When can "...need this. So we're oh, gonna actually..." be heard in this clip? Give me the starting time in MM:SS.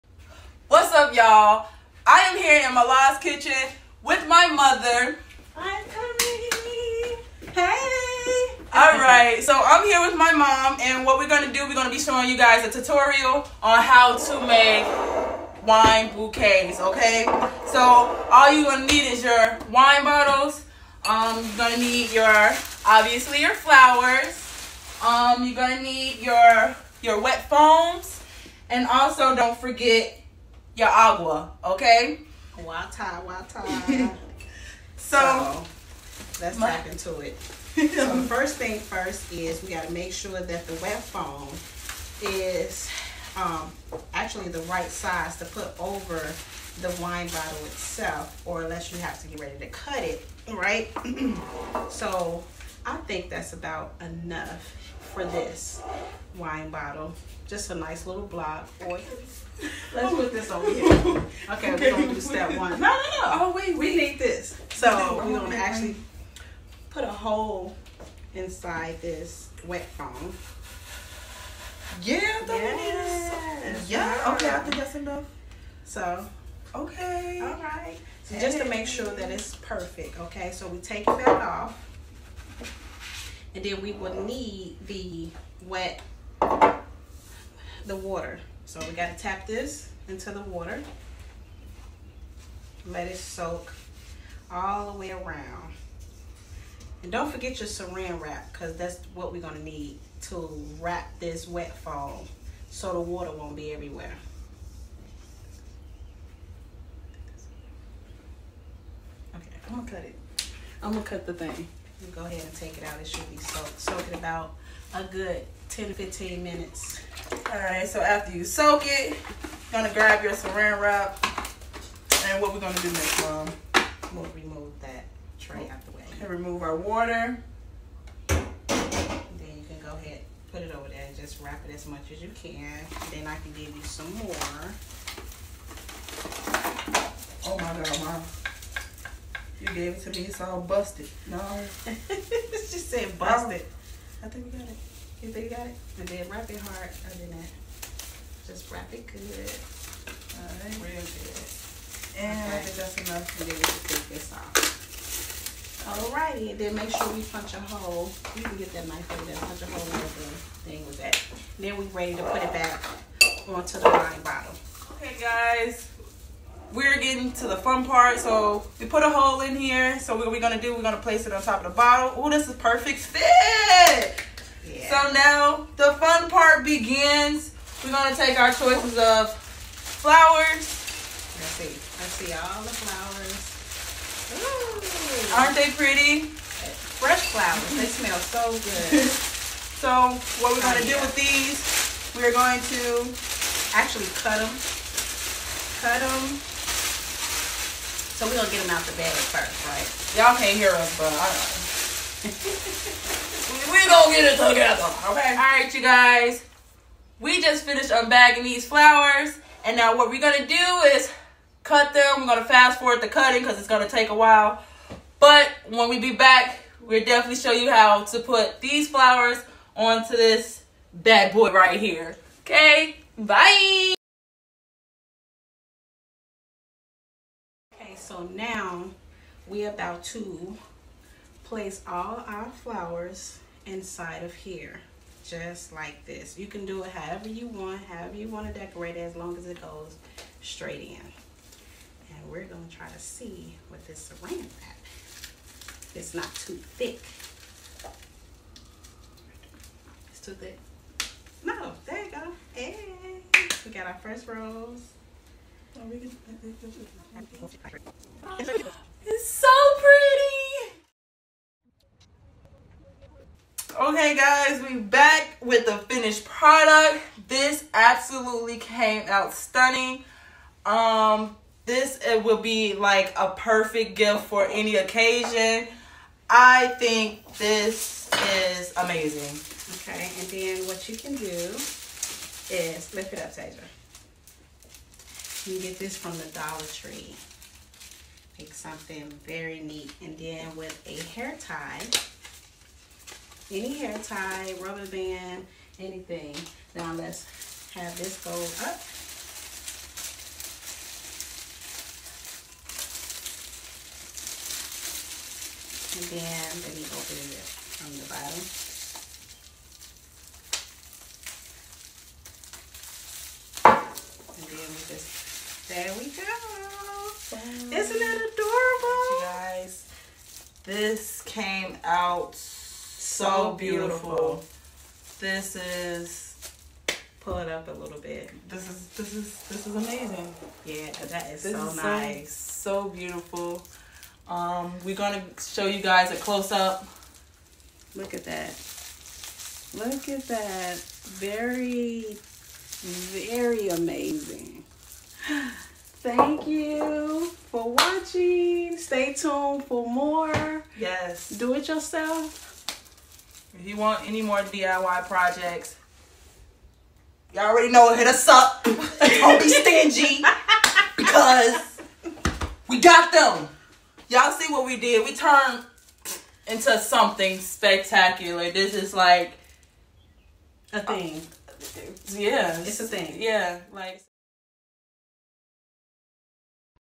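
01:03.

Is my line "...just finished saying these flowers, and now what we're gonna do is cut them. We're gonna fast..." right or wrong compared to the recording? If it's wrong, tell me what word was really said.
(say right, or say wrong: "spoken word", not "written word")
wrong: "unbagging", not "saying".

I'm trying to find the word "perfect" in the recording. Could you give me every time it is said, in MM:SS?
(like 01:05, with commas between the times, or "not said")
01:19, 02:52, 04:33.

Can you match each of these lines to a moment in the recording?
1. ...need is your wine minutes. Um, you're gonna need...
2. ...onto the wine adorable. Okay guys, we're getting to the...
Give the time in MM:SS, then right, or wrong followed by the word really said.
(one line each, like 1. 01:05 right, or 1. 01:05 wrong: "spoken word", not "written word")
1. 00:18 wrong: "bottles", not "minutes"
2. 02:43 wrong: "bottle", not "adorable".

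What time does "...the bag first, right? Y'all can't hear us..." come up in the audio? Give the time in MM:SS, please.
03:18.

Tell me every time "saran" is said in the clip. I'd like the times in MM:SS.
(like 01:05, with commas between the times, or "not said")
01:37, 02:00, 04:04.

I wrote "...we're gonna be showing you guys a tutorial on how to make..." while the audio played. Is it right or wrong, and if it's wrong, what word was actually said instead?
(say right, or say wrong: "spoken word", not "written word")
right.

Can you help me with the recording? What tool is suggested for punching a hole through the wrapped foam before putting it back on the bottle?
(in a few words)
knife.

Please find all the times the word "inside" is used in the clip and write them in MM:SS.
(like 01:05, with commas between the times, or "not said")
01:08, 03:53.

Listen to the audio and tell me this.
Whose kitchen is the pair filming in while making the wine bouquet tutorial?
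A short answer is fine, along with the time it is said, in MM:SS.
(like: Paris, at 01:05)
Mala's, at 00:02.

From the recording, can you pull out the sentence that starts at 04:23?
Okay guys, we back with the finished product.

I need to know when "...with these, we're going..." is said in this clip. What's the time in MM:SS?
03:11.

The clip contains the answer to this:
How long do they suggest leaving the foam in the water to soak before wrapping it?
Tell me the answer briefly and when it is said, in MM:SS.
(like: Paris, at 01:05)
10 to 15 minutes, at 01:55.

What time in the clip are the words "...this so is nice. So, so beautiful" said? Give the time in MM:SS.
05:31.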